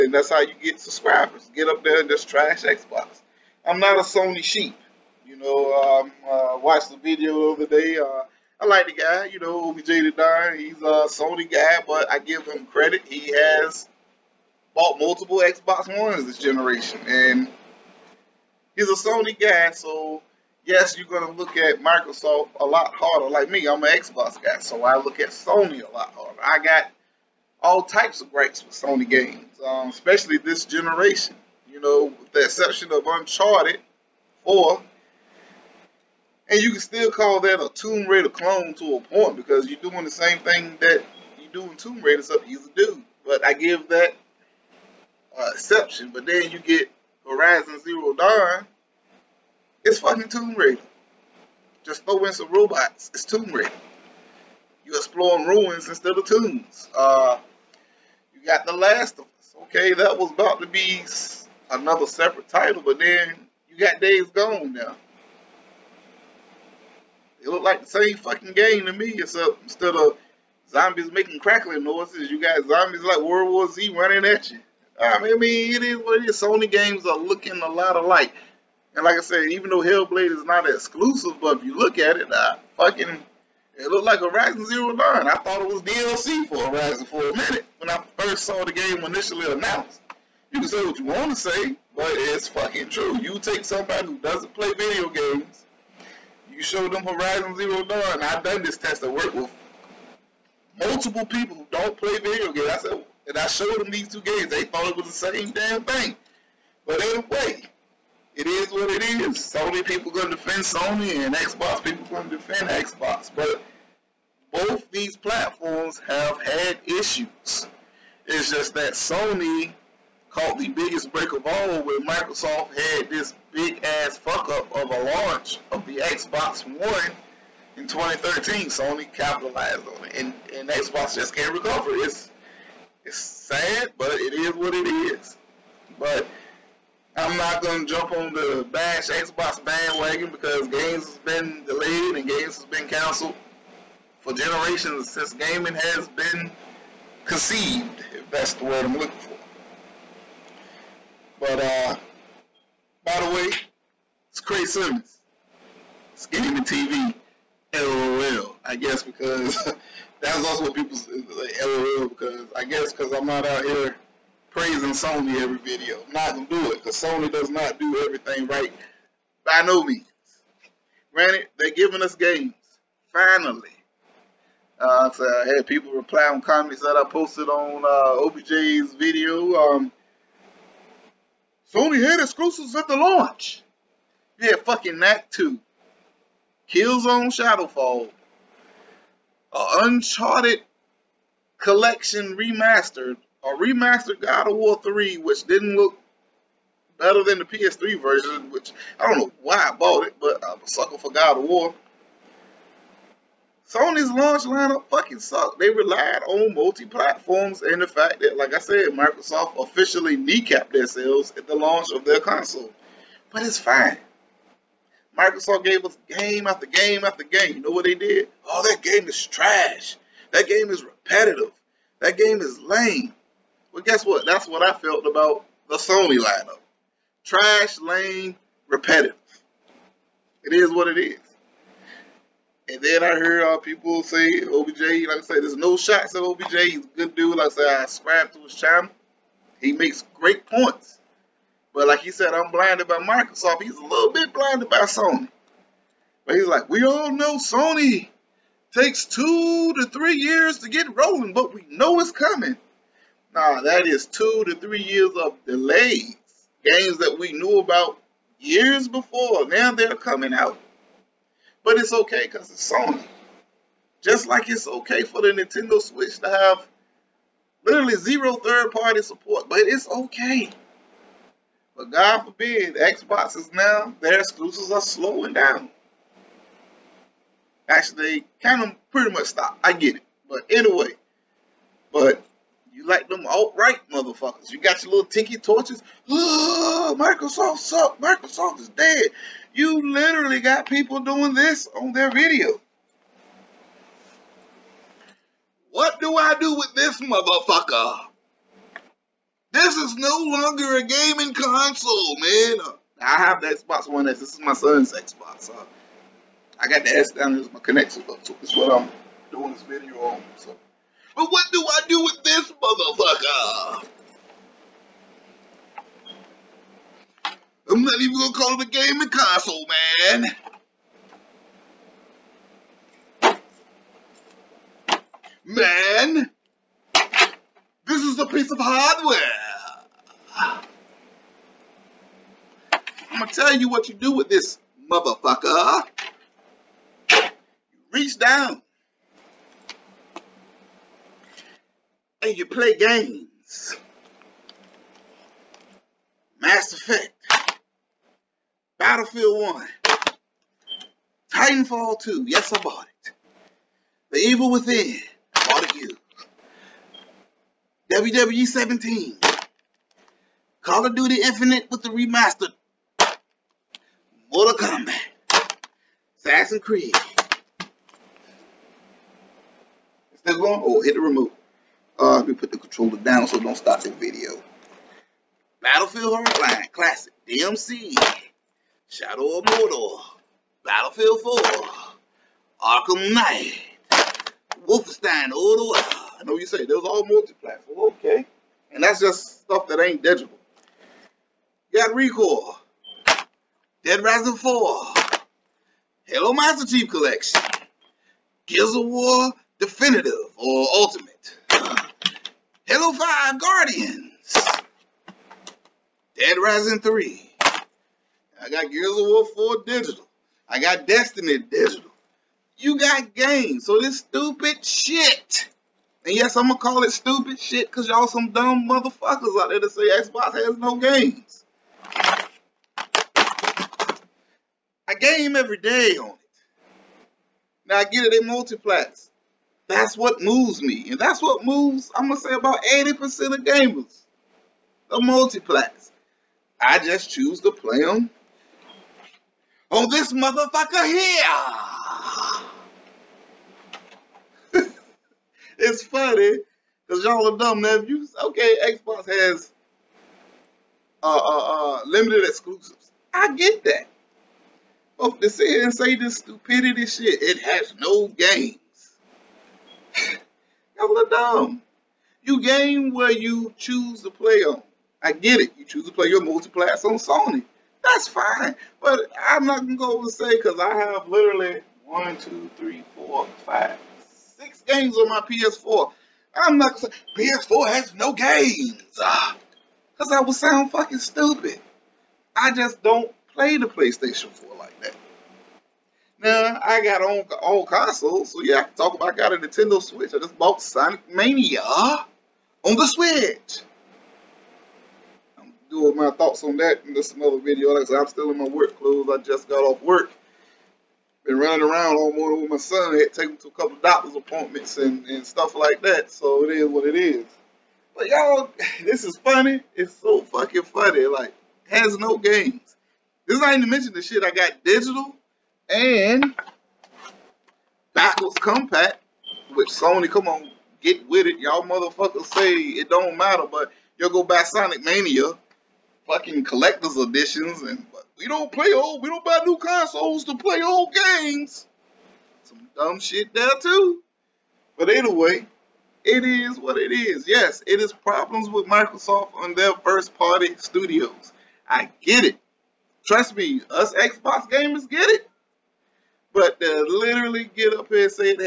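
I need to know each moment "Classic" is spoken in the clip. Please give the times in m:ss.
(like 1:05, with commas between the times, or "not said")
6:16.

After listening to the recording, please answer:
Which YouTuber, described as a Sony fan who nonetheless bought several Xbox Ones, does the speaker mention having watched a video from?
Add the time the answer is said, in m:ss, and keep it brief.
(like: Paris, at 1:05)
OBJ the Don, at 0:09.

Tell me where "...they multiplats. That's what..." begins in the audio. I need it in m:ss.
7:08.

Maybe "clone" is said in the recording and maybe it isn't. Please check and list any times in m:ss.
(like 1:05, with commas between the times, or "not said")
0:38.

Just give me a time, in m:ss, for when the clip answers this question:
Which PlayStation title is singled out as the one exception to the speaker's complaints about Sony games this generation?
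0:33.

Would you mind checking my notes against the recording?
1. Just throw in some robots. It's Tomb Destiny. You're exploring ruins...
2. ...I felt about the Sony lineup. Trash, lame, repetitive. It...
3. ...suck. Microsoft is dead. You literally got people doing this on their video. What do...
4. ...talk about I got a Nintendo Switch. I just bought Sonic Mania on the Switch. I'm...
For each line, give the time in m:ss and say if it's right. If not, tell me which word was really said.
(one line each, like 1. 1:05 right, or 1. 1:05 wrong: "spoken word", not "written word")
1. 0:51 wrong: "Raider", not "Destiny"
2. 3:44 right
3. 4:47 right
4. 8:08 right.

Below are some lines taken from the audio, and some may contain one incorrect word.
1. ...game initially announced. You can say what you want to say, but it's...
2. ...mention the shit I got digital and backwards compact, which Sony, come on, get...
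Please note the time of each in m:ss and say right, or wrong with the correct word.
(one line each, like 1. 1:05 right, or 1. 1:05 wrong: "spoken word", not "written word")
1. 1:28 right
2. 8:33 right.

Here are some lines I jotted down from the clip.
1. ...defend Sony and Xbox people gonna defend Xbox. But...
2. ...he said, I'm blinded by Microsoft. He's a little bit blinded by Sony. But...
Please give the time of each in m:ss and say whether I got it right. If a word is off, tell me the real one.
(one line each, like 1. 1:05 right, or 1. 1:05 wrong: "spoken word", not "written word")
1. 1:50 right
2. 4:02 right.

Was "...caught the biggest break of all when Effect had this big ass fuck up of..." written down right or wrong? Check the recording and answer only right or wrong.
wrong.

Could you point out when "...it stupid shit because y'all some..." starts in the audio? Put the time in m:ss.
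6:56.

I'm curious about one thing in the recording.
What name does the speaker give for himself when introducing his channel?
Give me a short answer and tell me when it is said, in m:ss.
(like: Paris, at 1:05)
Craig Simmons, at 2:34.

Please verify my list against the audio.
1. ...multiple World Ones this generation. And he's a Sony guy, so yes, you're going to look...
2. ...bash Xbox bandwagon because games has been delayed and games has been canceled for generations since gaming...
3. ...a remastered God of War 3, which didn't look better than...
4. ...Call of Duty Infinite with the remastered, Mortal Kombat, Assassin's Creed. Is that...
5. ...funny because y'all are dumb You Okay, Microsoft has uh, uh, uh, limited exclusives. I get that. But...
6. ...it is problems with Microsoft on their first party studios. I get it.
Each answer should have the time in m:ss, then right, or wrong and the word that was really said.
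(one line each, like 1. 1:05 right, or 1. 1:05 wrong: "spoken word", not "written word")
1. 0:14 wrong: "Xbox", not "World"
2. 2:18 right
3. 3:13 right
4. 6:00 right
5. 7:25 wrong: "Xbox", not "Microsoft"
6. 8:57 right.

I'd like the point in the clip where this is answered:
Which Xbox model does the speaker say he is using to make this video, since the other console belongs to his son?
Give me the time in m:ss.
5:03.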